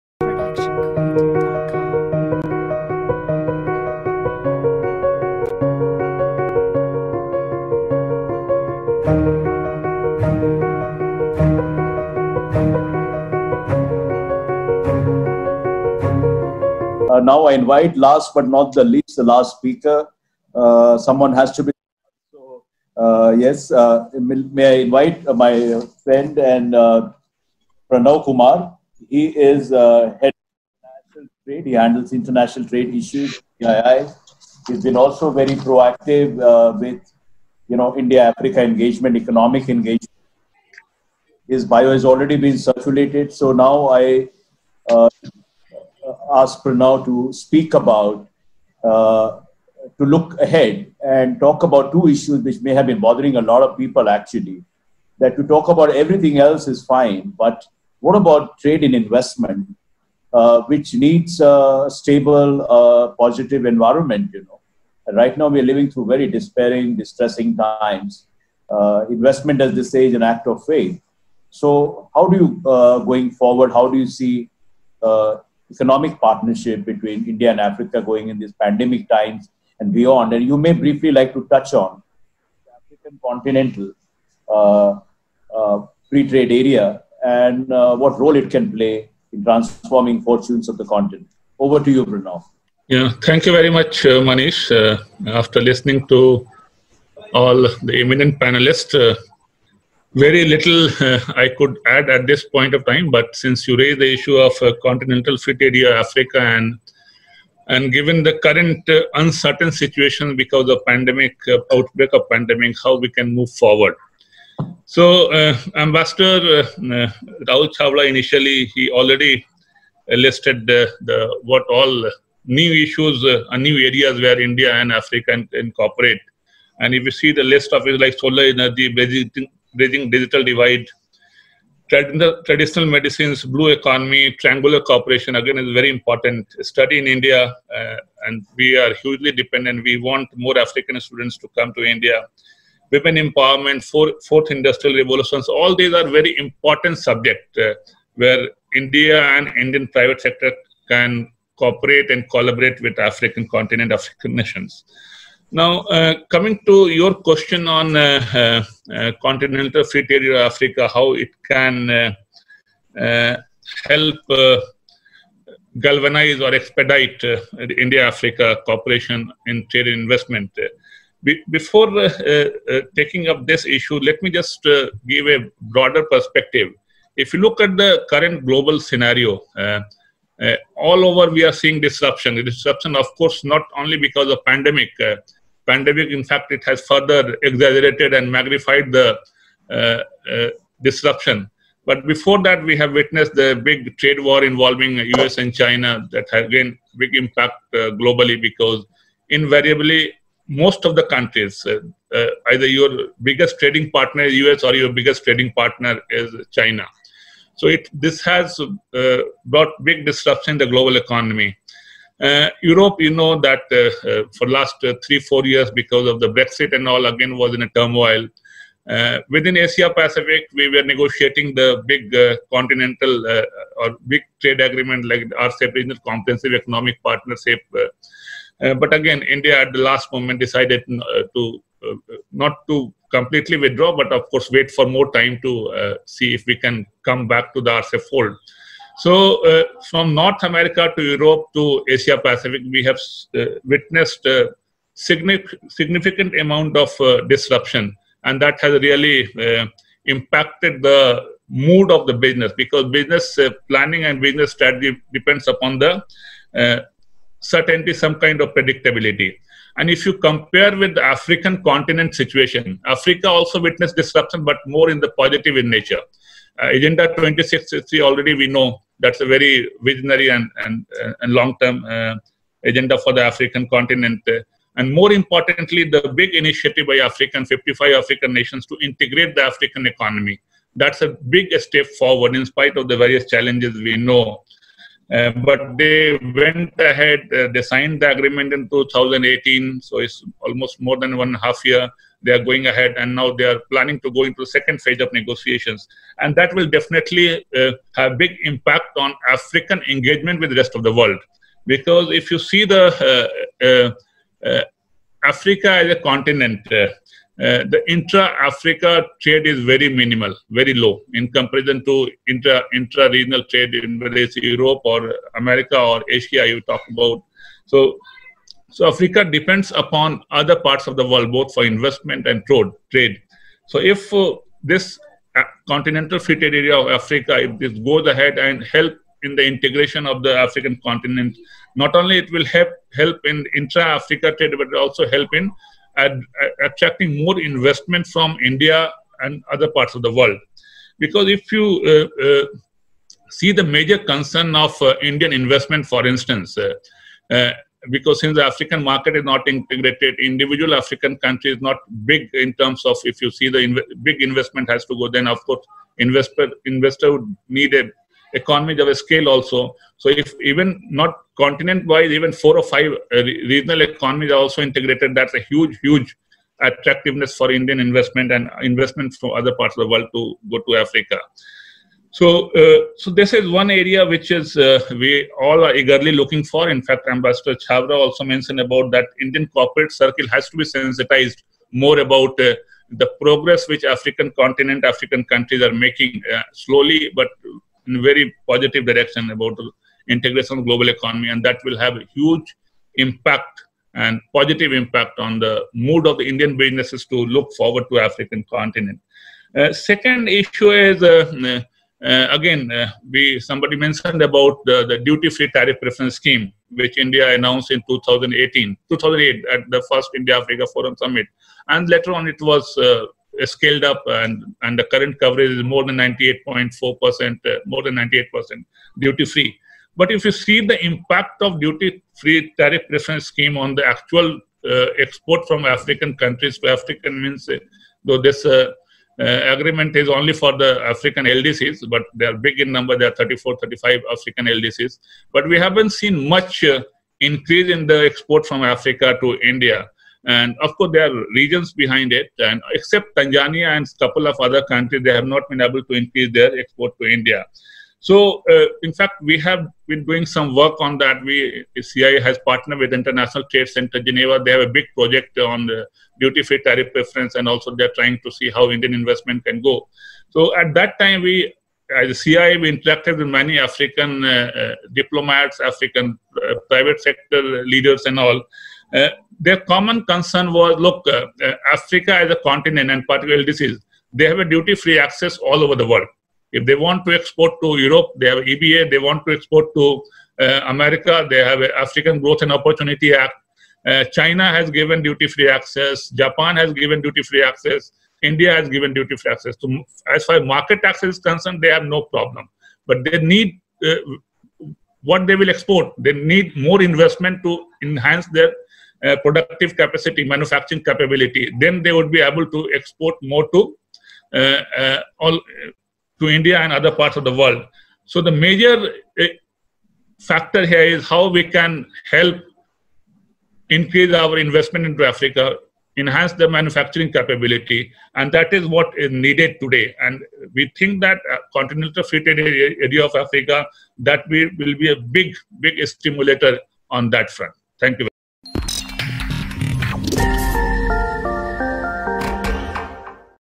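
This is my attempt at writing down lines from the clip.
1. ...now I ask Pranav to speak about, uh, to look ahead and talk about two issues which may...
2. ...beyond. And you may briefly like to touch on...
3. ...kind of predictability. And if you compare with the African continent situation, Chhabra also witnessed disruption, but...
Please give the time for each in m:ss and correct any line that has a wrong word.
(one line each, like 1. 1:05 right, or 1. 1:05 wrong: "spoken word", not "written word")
1. 0:43 right
2. 1:19 right
3. 4:18 wrong: "Africa", not "Chhabra".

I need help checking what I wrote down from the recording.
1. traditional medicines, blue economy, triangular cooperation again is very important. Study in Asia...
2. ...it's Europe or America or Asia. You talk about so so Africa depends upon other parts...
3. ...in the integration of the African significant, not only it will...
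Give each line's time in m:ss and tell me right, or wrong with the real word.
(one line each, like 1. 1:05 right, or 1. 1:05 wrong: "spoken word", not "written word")
1. 2:12 wrong: "India", not "Asia"
2. 5:14 right
3. 5:29 wrong: "continent", not "significant".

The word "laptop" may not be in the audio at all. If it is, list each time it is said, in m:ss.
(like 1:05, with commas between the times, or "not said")
not said.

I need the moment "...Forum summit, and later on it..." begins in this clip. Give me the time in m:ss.
6:50.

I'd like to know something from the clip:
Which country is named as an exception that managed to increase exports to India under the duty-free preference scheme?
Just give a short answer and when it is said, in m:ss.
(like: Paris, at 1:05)
Tanzania, at 7:23.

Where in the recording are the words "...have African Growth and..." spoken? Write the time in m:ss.
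8:01.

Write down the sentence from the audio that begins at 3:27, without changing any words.
So it this has uh, brought big disruption in the global economy.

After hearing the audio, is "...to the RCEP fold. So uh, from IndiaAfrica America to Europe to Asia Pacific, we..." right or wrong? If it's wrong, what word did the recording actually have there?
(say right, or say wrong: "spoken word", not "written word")
wrong: "North", not "IndiaAfrica".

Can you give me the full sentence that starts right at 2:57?
If you look at the current global scenario, all over we are seeing disruption.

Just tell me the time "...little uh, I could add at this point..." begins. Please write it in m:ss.
1:40.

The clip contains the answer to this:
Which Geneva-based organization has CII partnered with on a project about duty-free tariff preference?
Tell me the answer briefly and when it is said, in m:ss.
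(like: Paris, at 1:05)
International Trade Center, at 7:32.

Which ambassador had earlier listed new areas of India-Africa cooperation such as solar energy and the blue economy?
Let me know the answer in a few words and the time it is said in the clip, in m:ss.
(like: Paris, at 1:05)
Rahul Chhabra, at 1:57.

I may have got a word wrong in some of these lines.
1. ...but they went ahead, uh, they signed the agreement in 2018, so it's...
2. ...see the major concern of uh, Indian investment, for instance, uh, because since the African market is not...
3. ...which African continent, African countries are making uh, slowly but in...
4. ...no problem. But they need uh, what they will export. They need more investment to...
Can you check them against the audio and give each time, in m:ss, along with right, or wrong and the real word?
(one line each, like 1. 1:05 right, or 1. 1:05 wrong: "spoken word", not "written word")
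1. 4:45 right
2. 5:43 right
3. 6:23 right
4. 8:11 right.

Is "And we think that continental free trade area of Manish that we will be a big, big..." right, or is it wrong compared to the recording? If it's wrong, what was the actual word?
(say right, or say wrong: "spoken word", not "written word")
wrong: "Africa", not "Manish".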